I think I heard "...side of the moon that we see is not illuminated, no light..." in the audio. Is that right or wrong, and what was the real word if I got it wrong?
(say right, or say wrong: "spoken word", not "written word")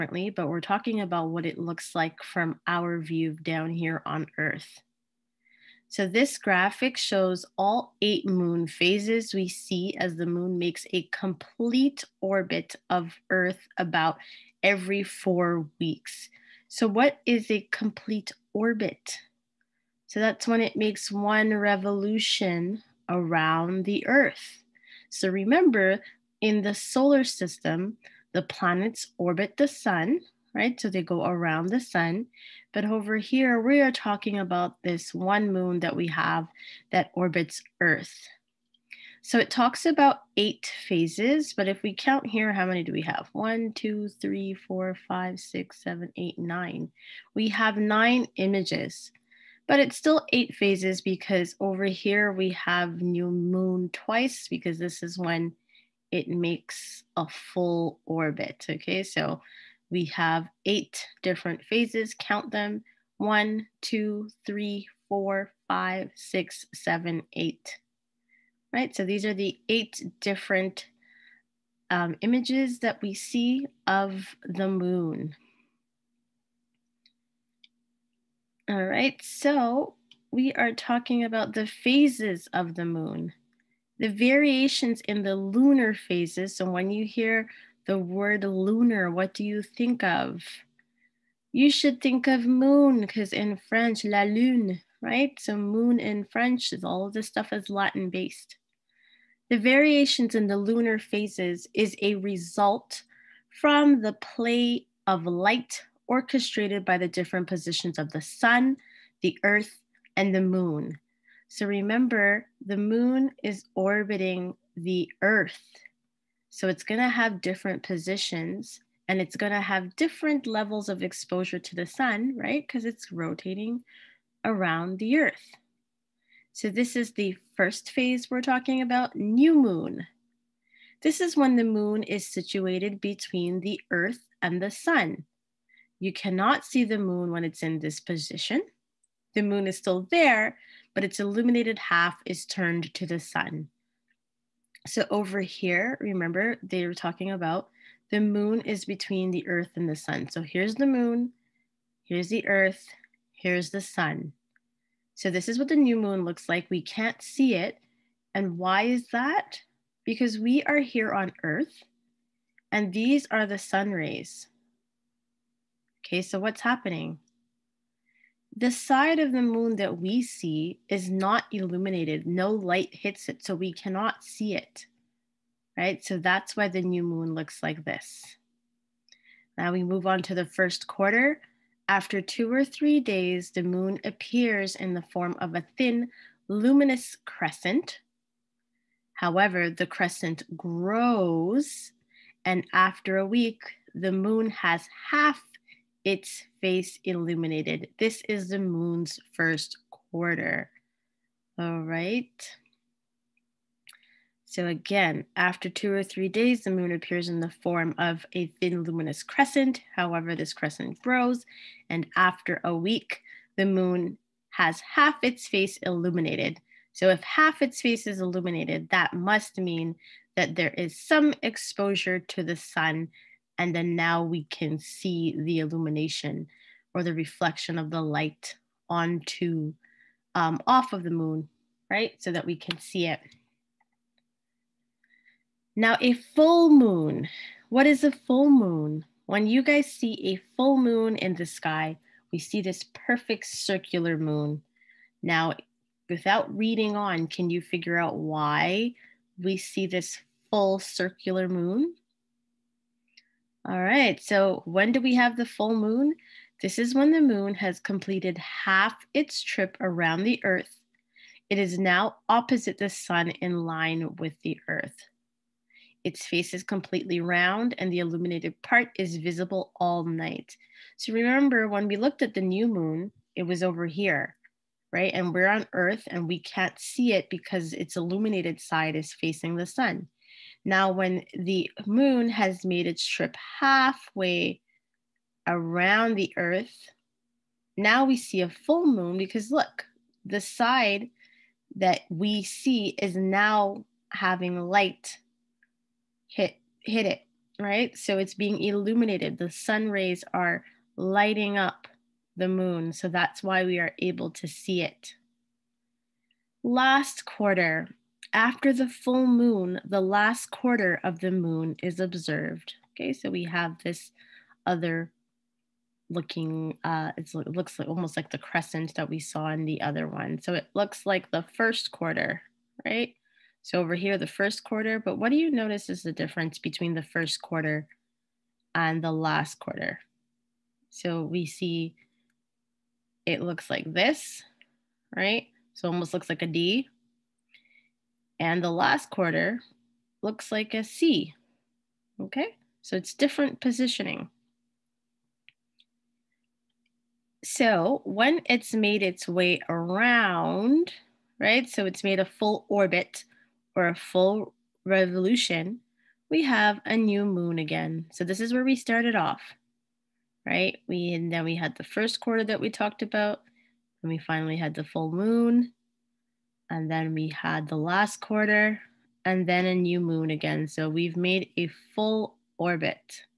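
right.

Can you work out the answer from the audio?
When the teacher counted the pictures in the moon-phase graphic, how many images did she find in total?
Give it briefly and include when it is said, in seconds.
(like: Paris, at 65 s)
9, at 47 s.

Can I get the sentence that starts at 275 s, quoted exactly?
And we're on earth and we can't see it because its illuminated side is facing the sun.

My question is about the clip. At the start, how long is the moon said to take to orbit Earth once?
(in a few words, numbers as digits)
About 4 weeks.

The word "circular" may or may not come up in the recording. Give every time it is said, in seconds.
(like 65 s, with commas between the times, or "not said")
243 s, 250 s.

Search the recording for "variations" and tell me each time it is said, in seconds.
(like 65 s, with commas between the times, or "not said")
84 s, 99 s.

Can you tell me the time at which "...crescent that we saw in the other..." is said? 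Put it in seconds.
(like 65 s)
318 s.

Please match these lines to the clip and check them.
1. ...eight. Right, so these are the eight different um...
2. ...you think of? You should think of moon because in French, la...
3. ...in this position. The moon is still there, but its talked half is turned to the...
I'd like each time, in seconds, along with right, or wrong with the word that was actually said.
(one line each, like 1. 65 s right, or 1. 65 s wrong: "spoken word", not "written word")
1. 67 s right
2. 89 s right
3. 137 s wrong: "illuminated", not "talked".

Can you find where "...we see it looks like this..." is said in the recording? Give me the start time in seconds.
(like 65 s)
331 s.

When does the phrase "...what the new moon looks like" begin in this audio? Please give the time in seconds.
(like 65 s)
155 s.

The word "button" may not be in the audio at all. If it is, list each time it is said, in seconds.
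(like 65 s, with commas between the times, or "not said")
not said.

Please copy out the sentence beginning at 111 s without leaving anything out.
So remember, the moon is orbiting the earth.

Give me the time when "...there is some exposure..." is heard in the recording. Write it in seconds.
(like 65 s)
220 s.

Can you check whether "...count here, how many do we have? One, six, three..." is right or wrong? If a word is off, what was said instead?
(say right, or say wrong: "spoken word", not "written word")
wrong: "two", not "six".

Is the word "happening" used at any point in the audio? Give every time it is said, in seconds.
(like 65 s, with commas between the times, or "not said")
166 s.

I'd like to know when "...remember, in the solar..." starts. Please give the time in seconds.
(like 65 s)
25 s.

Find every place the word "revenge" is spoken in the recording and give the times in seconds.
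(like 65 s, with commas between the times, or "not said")
not said.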